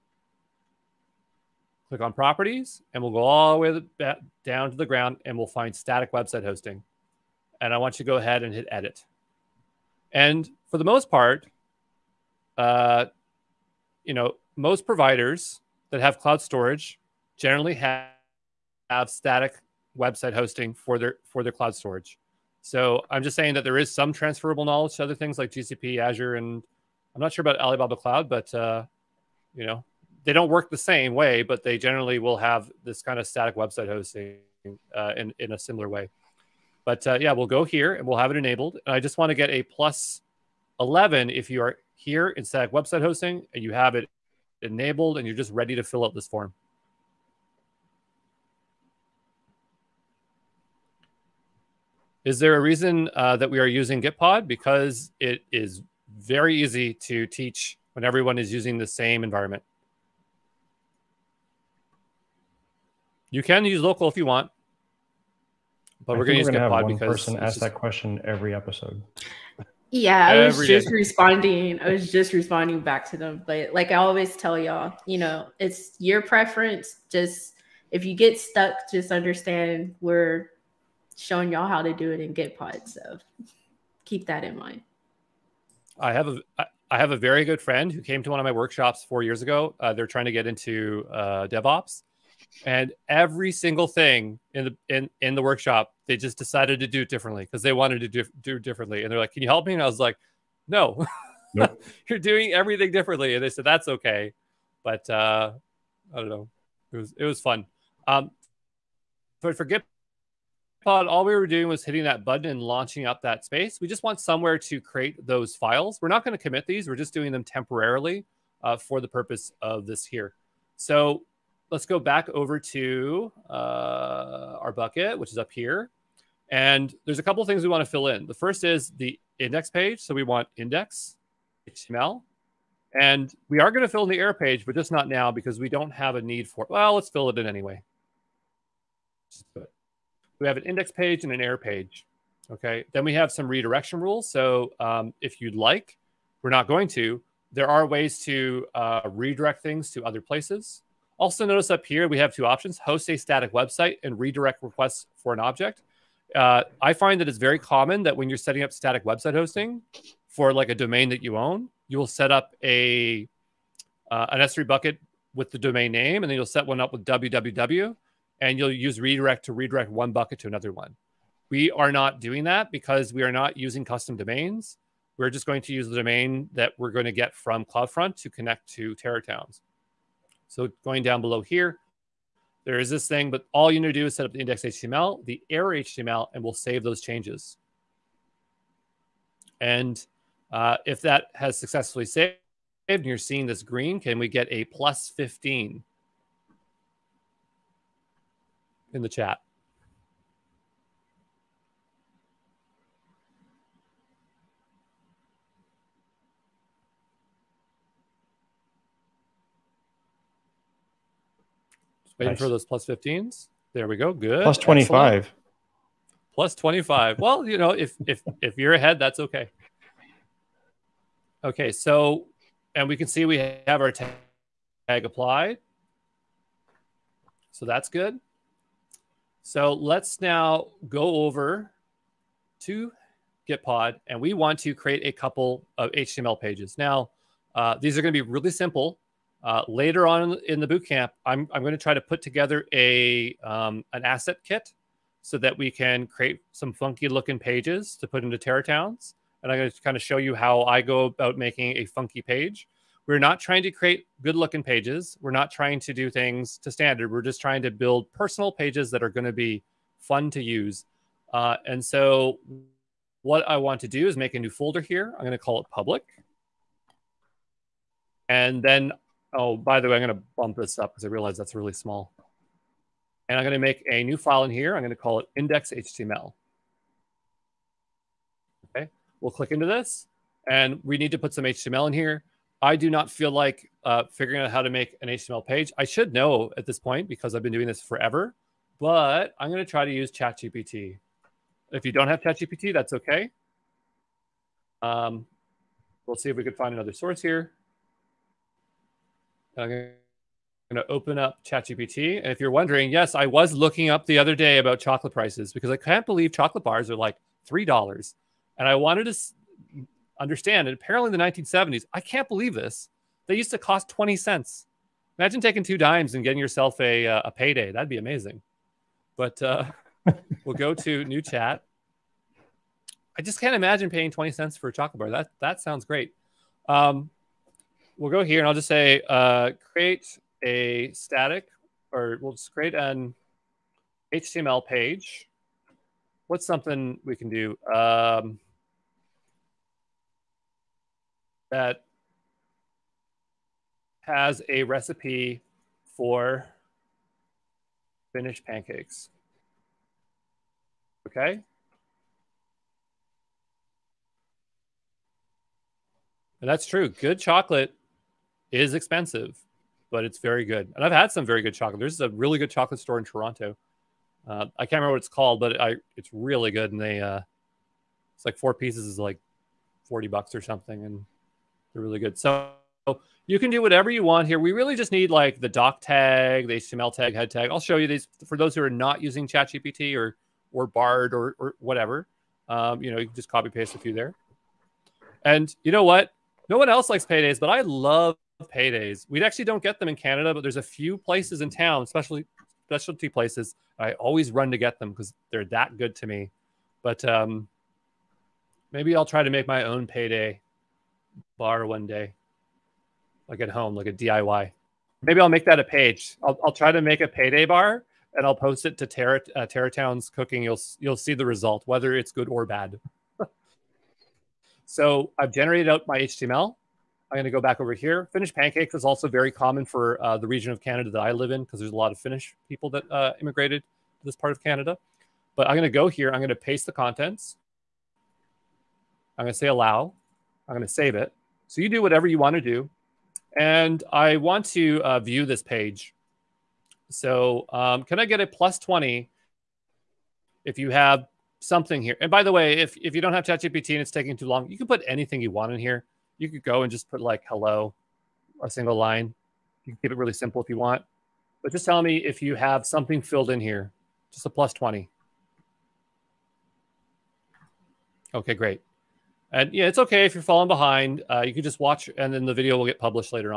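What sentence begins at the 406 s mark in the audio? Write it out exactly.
I'll, I'll try to make a payday bar and I'll post it to Terra, uh, Terra Town's cooking.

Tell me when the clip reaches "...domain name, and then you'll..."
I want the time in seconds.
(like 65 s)
165 s.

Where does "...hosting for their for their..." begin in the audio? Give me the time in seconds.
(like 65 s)
20 s.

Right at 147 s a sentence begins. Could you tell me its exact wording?
There are ways to uh, redirect things to other places.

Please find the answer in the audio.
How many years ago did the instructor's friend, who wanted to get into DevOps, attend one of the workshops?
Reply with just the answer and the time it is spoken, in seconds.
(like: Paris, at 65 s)
4 years, at 89 s.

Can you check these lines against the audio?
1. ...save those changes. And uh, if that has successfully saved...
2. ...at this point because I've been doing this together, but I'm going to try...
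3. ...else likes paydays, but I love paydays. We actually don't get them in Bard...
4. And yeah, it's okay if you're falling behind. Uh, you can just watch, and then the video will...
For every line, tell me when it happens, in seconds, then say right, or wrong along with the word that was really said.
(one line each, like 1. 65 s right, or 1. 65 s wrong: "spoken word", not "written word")
1. 186 s right
2. 286 s wrong: "forever", not "together"
3. 386 s wrong: "Canada", not "Bard"
4. 459 s right.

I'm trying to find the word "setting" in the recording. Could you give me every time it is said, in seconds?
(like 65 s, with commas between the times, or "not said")
158 s.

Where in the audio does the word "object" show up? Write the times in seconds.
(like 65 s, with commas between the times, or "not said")
155 s.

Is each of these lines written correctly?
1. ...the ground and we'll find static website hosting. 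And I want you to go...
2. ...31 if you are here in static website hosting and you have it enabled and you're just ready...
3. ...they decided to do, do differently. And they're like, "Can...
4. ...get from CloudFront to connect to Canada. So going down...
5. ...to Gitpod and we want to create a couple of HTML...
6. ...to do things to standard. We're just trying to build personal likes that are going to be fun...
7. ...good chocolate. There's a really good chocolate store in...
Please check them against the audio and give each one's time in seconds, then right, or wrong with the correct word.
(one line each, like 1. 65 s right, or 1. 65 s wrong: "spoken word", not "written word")
1. 4 s right
2. 40 s wrong: "11", not "31"
3. 97 s wrong: "wanted", not "decided"
4. 177 s wrong: "TerraTowns", not "Canada"
5. 232 s right
6. 255 s wrong: "pages", not "likes"
7. 361 s right.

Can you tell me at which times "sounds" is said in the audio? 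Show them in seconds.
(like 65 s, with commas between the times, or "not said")
325 s.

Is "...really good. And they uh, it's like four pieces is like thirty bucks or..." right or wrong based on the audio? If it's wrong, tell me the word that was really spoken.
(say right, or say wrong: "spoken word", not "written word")
wrong: "forty", not "thirty".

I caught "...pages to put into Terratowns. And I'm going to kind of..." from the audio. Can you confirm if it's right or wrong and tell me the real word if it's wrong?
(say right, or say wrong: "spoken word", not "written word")
right.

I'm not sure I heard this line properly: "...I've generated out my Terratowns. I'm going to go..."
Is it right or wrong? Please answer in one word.
wrong.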